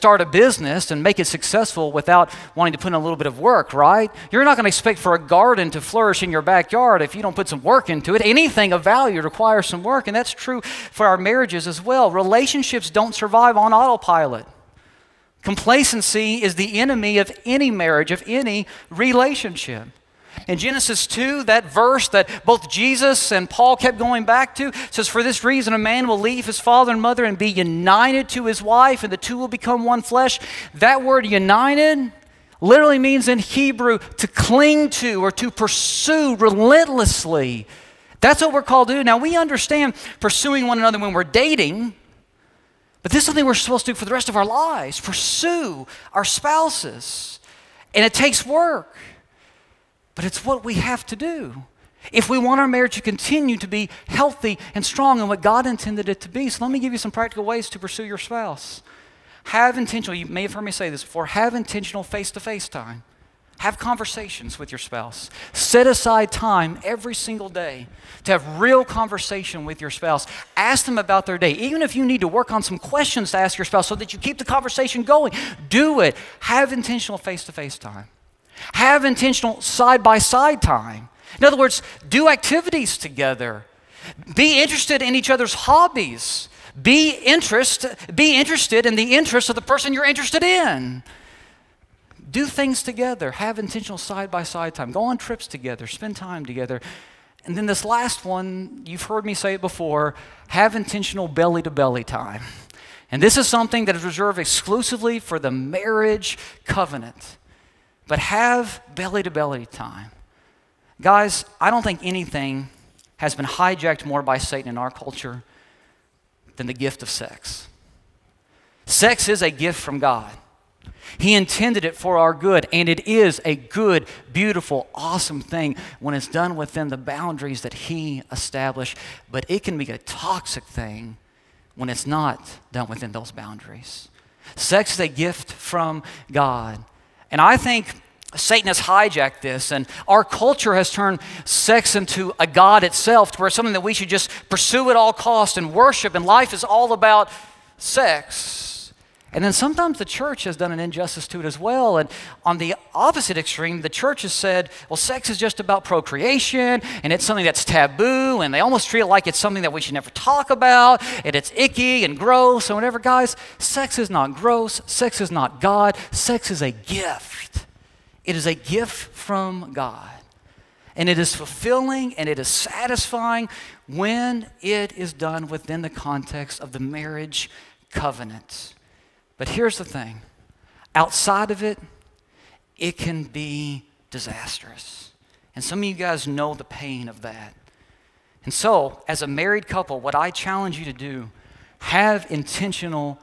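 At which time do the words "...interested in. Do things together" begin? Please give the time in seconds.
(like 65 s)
90 s.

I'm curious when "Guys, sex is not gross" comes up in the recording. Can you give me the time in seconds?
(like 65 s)
162 s.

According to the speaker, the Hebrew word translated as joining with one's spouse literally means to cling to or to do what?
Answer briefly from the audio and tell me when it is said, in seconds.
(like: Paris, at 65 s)
pursue relentlessly, at 35 s.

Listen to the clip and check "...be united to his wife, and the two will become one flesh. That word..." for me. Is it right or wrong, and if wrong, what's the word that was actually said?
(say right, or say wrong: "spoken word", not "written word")
right.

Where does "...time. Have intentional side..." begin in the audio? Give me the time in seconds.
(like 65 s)
77 s.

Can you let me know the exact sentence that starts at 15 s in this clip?
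Complacency is the enemy of any marriage, of any relationship.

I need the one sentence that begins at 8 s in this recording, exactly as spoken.
Anything of value requires some work, and that's true for our marriages as well.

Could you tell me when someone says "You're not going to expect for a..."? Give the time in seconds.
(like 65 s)
4 s.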